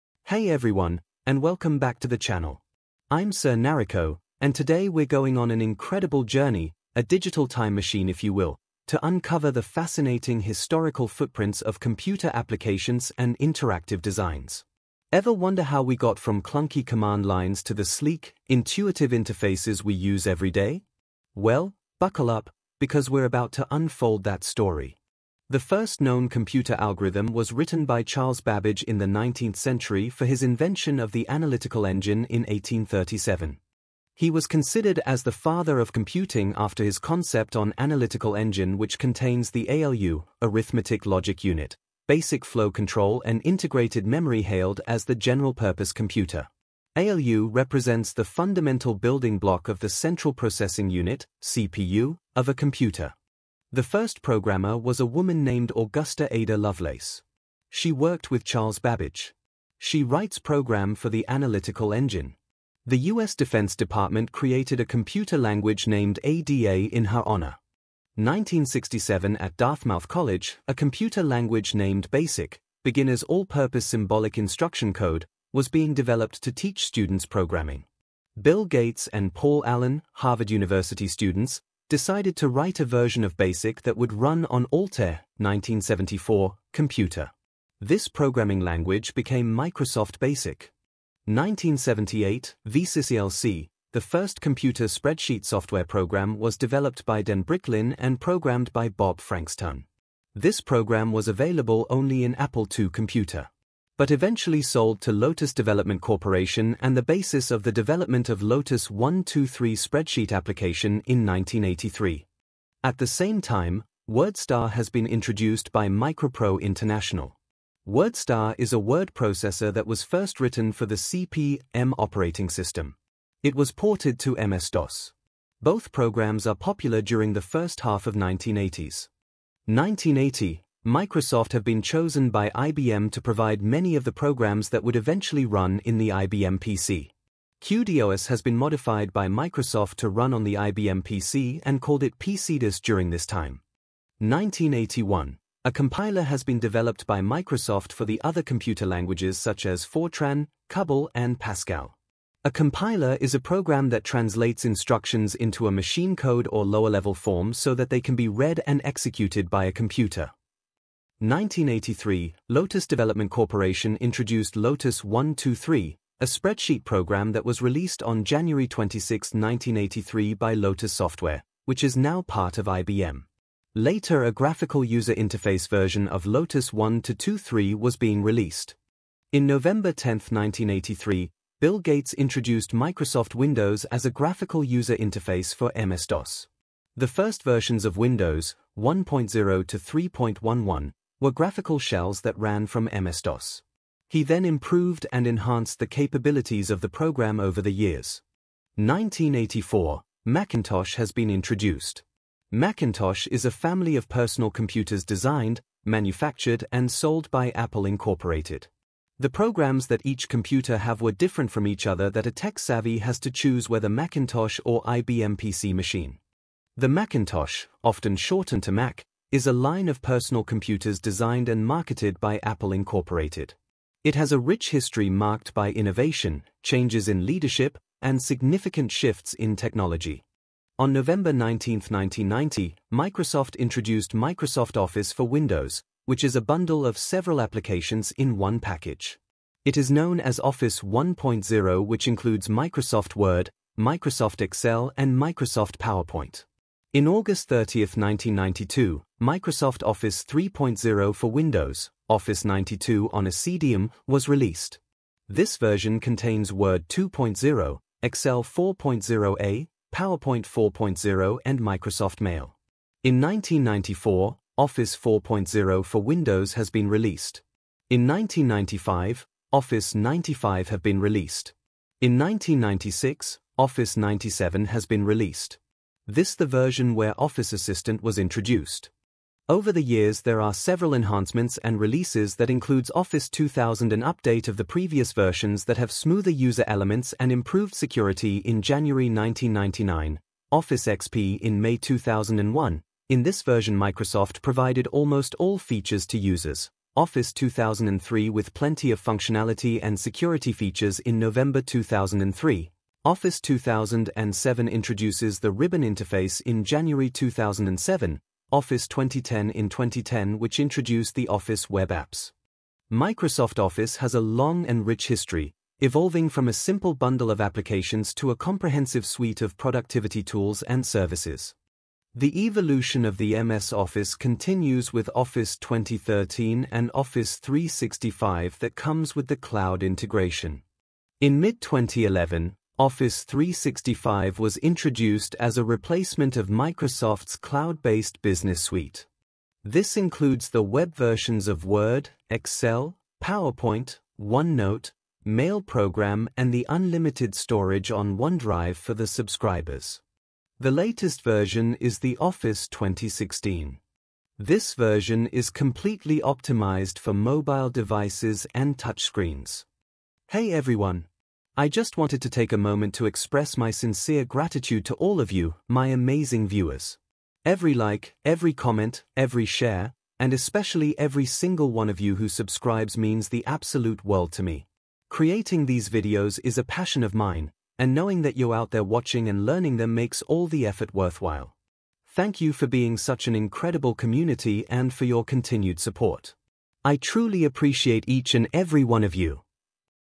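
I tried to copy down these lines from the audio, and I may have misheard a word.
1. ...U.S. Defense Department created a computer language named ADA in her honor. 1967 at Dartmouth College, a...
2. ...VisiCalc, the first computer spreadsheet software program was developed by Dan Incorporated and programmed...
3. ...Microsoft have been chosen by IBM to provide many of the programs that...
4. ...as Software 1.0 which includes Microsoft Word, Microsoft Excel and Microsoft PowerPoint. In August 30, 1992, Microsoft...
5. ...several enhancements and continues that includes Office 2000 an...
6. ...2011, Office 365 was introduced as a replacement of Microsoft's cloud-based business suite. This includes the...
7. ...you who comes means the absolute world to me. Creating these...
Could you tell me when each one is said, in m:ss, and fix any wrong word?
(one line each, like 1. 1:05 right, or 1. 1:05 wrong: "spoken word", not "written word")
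1. 1:03 right
2. 1:32 wrong: "Bricklin", not "Incorporated"
3. 2:10 right
4. 4:00 wrong: "Office", not "Software"
5. 4:40 wrong: "releases", not "continues"
6. 5:31 right
7. 6:11 wrong: "subscribes", not "comes".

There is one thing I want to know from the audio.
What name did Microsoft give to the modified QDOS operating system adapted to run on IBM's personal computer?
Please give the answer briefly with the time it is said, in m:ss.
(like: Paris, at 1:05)
PC DOS, at 2:22.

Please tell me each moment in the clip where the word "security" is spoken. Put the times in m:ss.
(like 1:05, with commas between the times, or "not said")
4:47, 4:59.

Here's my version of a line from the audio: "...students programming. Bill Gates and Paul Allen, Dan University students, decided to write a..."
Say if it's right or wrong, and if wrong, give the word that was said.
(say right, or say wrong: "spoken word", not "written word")
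wrong: "Harvard", not "Dan".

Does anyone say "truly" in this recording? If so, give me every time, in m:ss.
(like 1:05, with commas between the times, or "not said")
6:26.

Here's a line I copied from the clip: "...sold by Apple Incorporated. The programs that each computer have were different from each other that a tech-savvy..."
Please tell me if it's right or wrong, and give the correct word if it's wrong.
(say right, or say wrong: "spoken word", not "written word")
right.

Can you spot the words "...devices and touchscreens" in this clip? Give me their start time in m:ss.
5:57.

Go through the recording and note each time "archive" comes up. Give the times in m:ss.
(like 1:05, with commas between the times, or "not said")
not said.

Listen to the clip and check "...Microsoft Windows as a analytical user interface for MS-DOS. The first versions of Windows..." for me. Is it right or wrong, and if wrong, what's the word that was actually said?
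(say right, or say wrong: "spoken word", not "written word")
wrong: "graphical", not "analytical".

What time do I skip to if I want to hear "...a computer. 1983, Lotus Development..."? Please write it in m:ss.
2:39.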